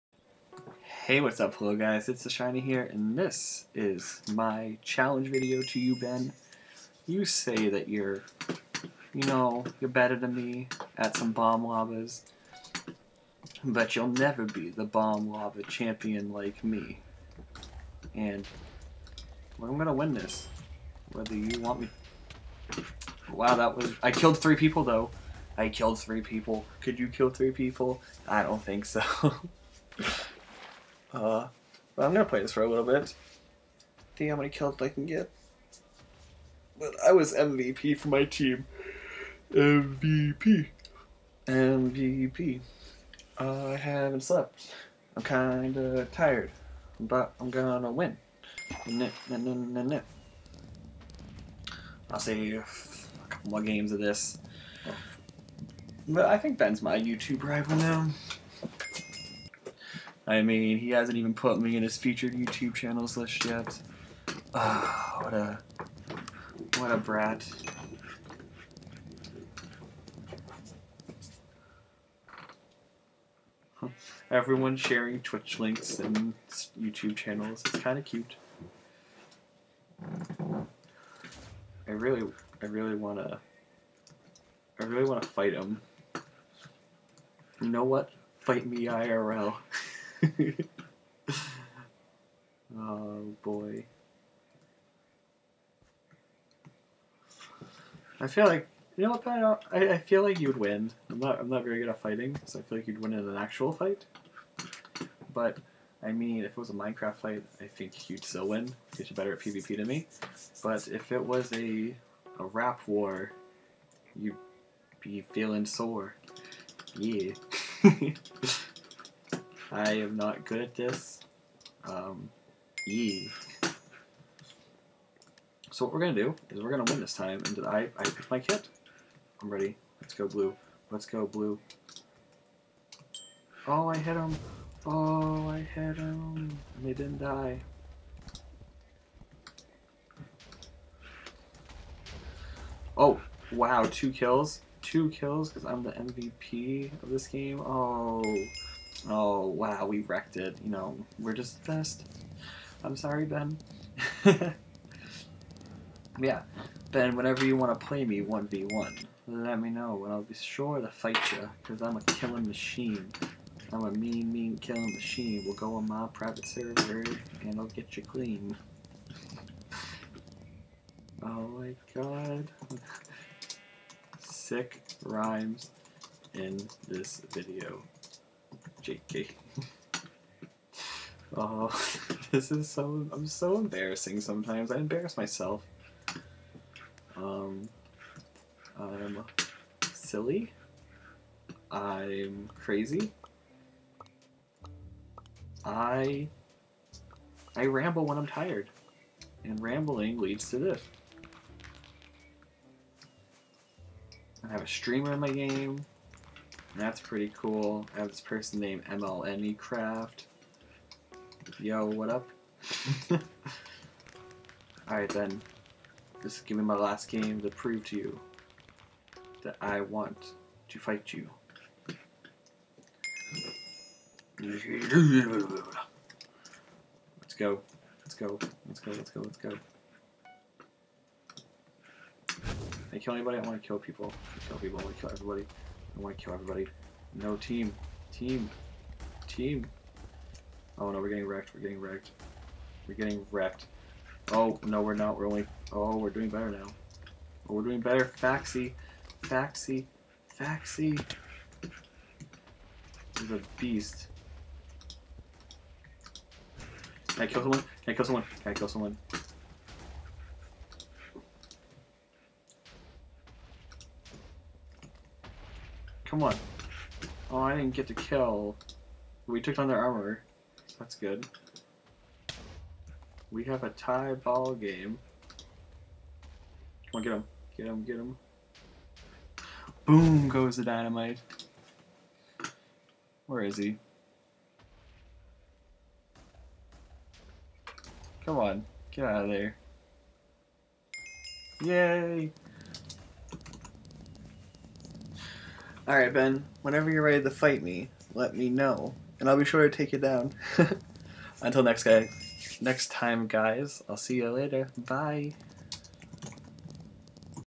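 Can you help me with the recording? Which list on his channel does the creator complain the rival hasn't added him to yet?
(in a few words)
featured YouTube channels.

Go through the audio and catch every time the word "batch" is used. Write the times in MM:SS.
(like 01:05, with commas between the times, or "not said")
not said.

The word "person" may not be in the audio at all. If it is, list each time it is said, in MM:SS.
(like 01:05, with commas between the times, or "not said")
03:28.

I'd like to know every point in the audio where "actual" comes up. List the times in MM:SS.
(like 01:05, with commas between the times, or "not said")
01:43.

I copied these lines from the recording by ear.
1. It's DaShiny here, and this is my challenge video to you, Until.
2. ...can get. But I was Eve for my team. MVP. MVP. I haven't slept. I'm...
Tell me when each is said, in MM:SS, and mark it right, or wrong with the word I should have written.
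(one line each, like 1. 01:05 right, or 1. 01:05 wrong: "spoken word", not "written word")
1. 00:02 wrong: "Ben", not "Until"
2. 00:34 wrong: "MVP", not "Eve".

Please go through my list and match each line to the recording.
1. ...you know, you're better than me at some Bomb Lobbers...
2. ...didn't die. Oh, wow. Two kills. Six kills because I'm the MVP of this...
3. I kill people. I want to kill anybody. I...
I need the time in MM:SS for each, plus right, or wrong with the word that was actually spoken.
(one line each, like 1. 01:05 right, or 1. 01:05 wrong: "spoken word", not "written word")
1. 00:09 right
2. 02:16 wrong: "Two", not "Six"
3. 03:54 wrong: "everybody", not "anybody".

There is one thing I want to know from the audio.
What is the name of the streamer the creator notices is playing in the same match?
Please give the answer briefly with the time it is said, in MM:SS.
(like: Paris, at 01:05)
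MLME Craft, at 03:28.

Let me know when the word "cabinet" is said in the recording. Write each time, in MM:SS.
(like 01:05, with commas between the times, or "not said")
not said.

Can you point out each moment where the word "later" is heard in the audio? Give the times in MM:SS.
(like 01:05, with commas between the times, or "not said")
05:04.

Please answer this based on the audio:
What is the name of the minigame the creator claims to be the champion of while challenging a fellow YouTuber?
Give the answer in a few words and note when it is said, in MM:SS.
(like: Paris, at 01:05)
Bomb Lobbers, at 00:14.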